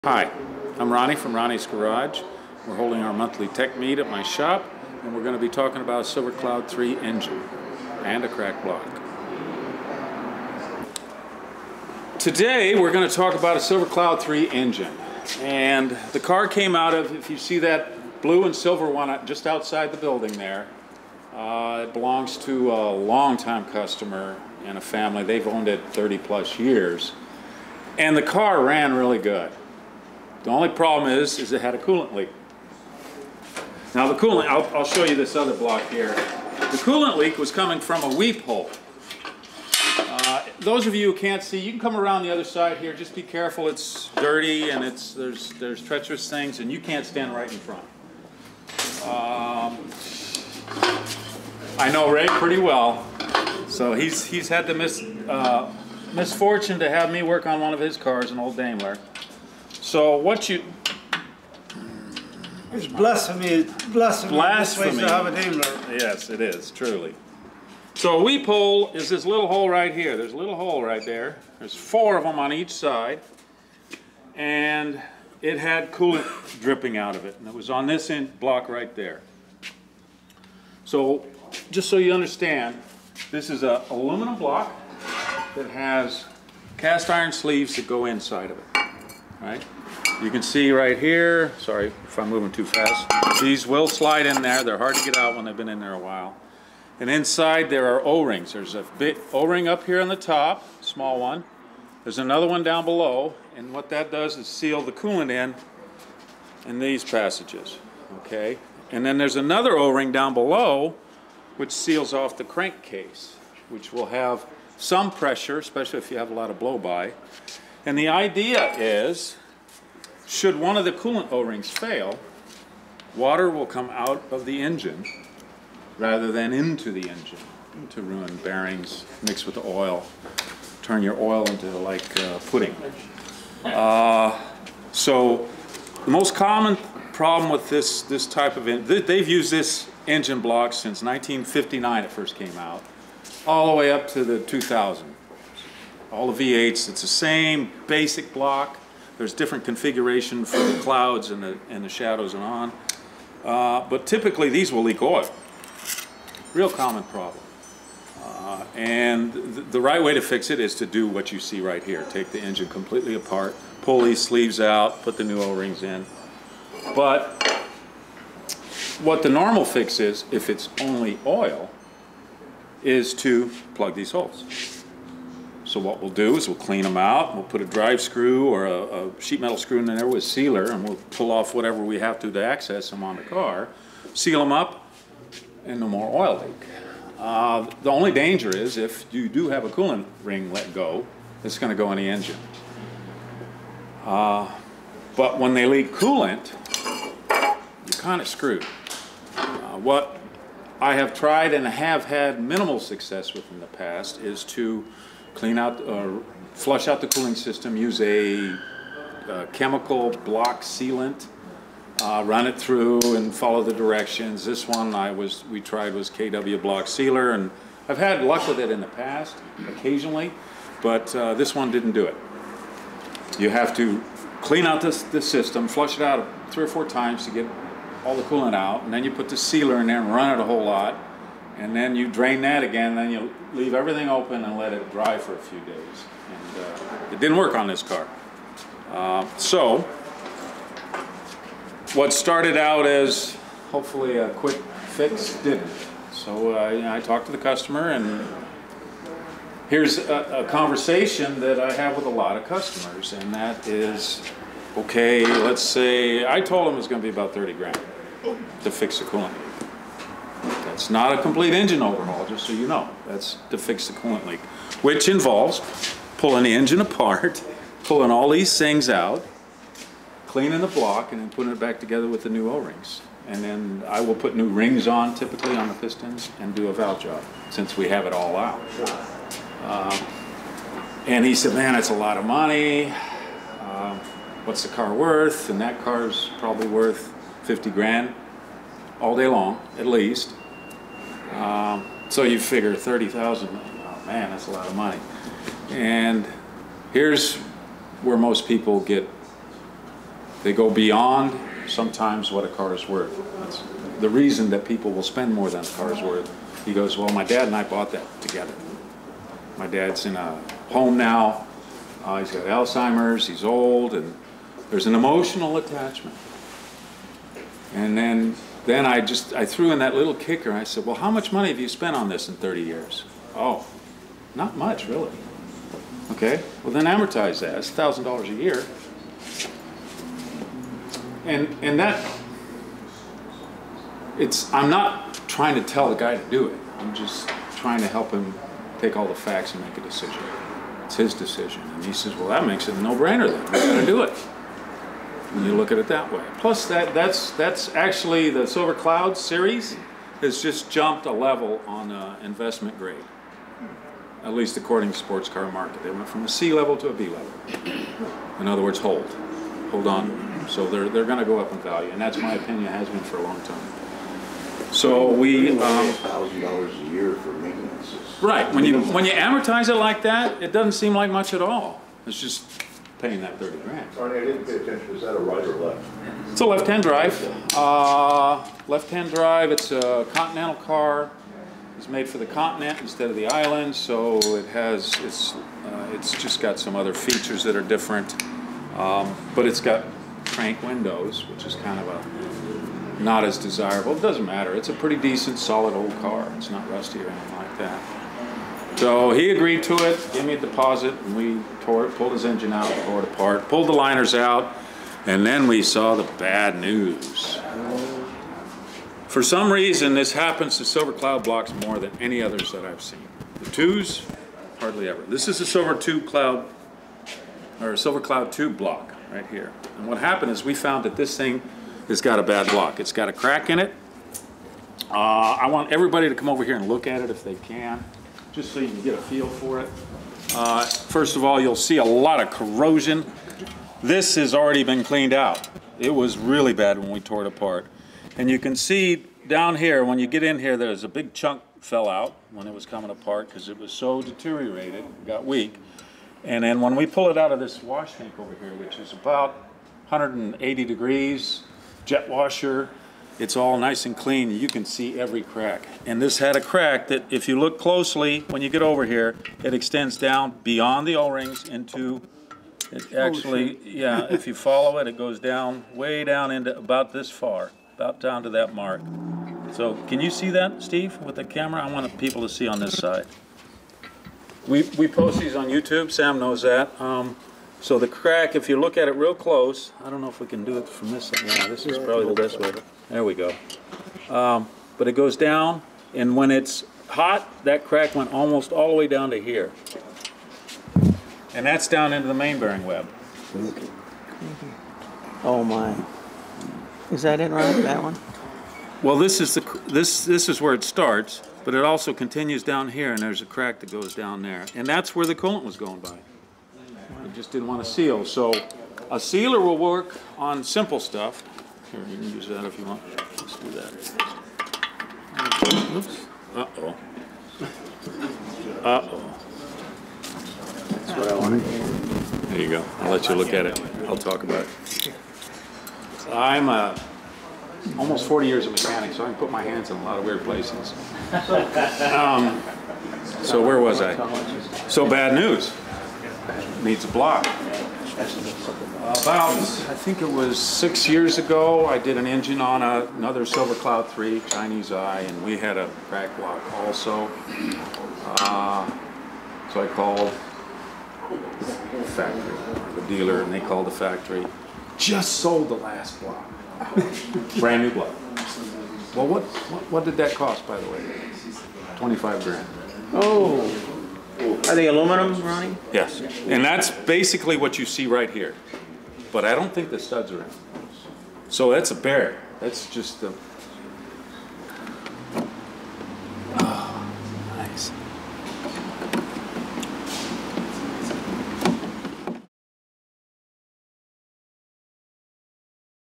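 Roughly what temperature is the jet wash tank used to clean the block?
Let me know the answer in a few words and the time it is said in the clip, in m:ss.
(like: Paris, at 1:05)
180 degrees, at 7:29.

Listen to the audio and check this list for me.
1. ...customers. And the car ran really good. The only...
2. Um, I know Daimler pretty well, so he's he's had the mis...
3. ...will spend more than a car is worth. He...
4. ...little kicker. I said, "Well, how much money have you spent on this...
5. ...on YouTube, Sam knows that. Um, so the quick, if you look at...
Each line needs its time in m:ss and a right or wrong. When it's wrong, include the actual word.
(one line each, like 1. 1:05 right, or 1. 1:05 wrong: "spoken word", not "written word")
1. 0:26 wrong: "years", not "customers"
2. 0:49 wrong: "Ray", not "Daimler"
3. 5:04 right
4. 5:19 right
5. 7:55 wrong: "crack", not "quick".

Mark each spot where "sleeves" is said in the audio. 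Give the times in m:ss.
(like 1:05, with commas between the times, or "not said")
1:27, 2:44.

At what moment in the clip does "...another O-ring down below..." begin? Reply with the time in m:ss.
1:49.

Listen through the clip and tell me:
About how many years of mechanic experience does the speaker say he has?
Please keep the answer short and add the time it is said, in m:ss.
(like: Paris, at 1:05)
Almost 40, at 8:47.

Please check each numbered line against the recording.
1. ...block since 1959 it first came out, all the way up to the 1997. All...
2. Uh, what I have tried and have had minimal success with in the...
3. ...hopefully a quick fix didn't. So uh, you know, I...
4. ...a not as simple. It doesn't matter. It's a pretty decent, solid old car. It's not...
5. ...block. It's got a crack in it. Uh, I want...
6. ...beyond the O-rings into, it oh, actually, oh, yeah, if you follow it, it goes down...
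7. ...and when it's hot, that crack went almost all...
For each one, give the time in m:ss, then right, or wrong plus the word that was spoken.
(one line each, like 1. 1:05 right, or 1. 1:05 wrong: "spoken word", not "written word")
1. 2:20 wrong: "2000", not "1997"
2. 3:19 right
3. 4:03 right
4. 6:31 wrong: "desirable", not "simple"
5. 7:02 right
6. 7:40 right
7. 8:05 right.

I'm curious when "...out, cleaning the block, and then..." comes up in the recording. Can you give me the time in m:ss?
4:28.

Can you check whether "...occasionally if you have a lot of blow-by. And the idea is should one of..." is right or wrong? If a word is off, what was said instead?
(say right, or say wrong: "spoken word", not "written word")
wrong: "especially", not "occasionally".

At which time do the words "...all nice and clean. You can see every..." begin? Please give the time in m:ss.
7:33.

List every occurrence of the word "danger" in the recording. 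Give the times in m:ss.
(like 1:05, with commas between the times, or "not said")
3:08.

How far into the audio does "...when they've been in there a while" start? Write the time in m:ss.
1:35.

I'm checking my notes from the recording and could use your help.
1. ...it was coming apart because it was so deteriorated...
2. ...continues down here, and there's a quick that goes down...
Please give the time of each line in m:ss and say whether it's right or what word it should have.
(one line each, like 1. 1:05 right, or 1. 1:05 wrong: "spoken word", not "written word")
1. 7:22 right
2. 8:21 wrong: "crack", not "quick".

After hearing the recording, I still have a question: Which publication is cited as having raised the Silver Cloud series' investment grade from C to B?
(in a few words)
Sports Car Market.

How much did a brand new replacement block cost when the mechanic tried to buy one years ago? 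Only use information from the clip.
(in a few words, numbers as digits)
$25,000.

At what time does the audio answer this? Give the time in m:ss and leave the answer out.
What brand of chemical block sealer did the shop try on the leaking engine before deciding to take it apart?
3:36.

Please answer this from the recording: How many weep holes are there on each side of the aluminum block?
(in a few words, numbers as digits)
4.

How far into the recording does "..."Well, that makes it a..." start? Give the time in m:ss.
5:42.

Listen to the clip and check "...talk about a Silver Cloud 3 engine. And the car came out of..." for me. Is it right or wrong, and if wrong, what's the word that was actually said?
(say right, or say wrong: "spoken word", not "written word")
right.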